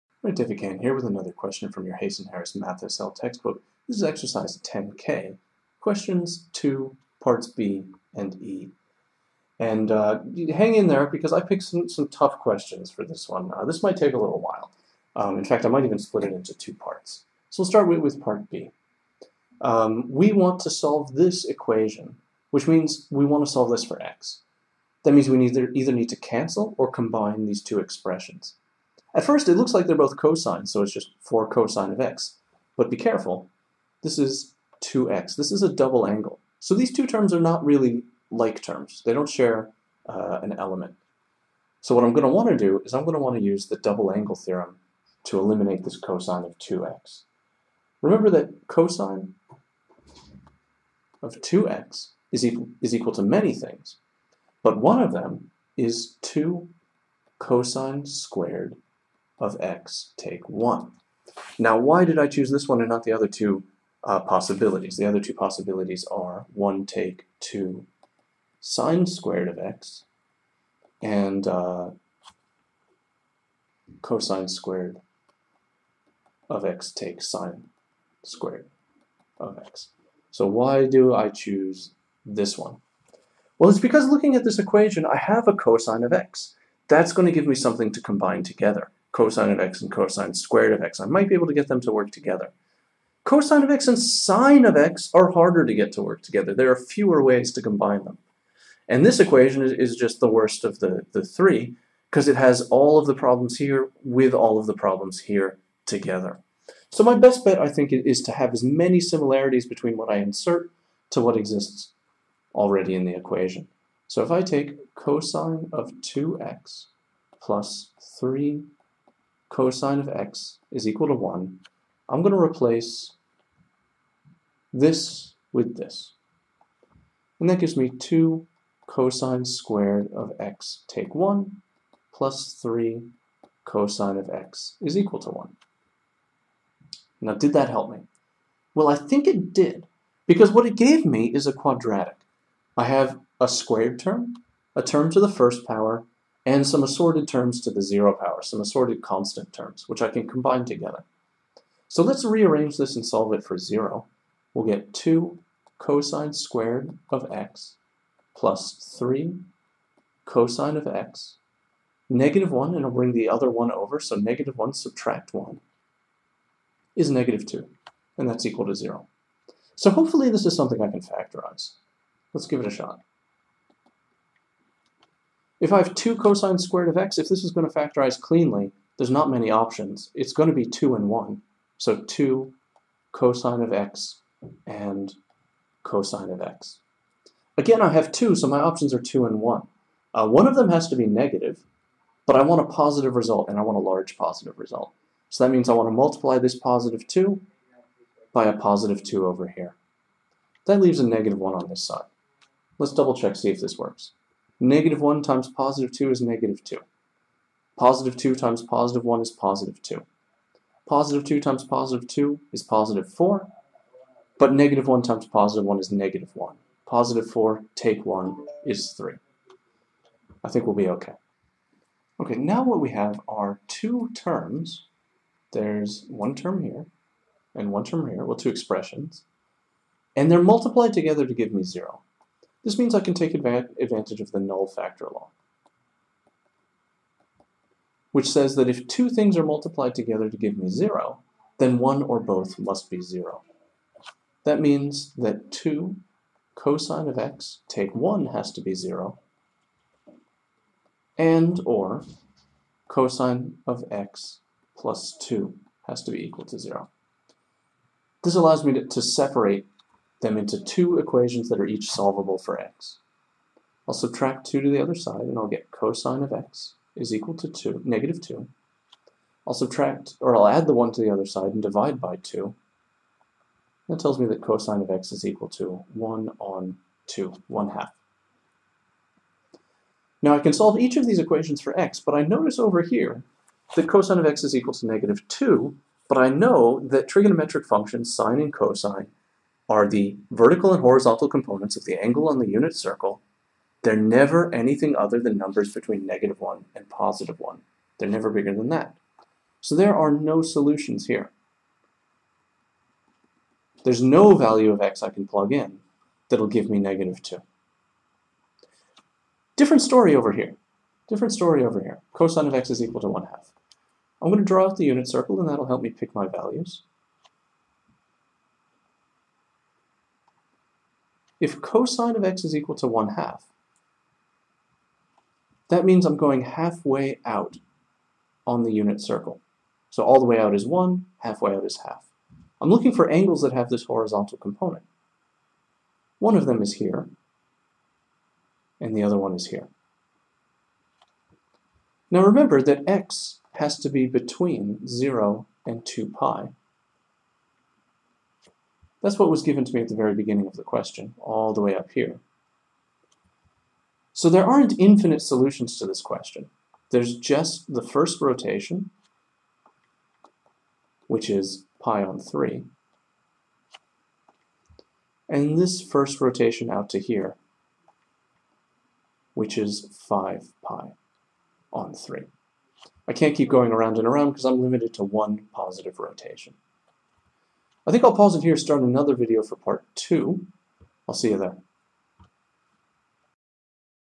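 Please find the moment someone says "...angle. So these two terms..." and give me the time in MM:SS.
00:36.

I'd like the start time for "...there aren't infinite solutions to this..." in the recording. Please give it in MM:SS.
05:54.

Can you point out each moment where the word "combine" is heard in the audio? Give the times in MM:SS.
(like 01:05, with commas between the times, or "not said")
00:26, 01:28, 01:37, 02:30.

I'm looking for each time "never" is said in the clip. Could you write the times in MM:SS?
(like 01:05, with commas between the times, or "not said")
04:53, 04:58.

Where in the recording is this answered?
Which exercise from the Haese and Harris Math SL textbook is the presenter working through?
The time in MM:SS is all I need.
00:04.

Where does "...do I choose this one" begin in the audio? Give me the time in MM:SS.
01:20.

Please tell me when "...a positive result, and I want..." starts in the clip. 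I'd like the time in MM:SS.
03:12.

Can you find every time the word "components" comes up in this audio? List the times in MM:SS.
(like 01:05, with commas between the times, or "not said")
04:51, 05:34.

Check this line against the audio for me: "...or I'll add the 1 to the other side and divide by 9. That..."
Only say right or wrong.
wrong.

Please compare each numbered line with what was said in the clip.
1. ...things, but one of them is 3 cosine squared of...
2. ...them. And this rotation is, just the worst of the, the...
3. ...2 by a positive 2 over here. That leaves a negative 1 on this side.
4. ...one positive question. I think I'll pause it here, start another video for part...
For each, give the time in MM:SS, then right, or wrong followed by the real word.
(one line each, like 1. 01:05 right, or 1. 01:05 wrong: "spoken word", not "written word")
1. 00:53 wrong: "2", not "3"
2. 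01:38 wrong: "equation", not "rotation"
3. 03:17 right
4. 06:15 wrong: "rotation", not "question".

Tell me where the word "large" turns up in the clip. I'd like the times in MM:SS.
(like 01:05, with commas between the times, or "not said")
03:13.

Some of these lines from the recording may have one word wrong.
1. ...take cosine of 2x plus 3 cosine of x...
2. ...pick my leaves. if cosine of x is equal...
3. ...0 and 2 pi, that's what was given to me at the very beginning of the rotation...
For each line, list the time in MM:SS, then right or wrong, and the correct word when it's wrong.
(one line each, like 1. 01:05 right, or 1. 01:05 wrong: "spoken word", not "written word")
1. 01:54 right
2. 05:15 wrong: "values", not "leaves"
3. 05:44 wrong: "question", not "rotation".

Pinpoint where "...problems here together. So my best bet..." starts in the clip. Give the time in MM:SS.
01:44.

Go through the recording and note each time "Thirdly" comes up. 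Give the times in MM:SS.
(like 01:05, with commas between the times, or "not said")
not said.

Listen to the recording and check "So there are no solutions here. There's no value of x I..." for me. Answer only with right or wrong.
right.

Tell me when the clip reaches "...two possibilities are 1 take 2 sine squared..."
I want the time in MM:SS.
01:05.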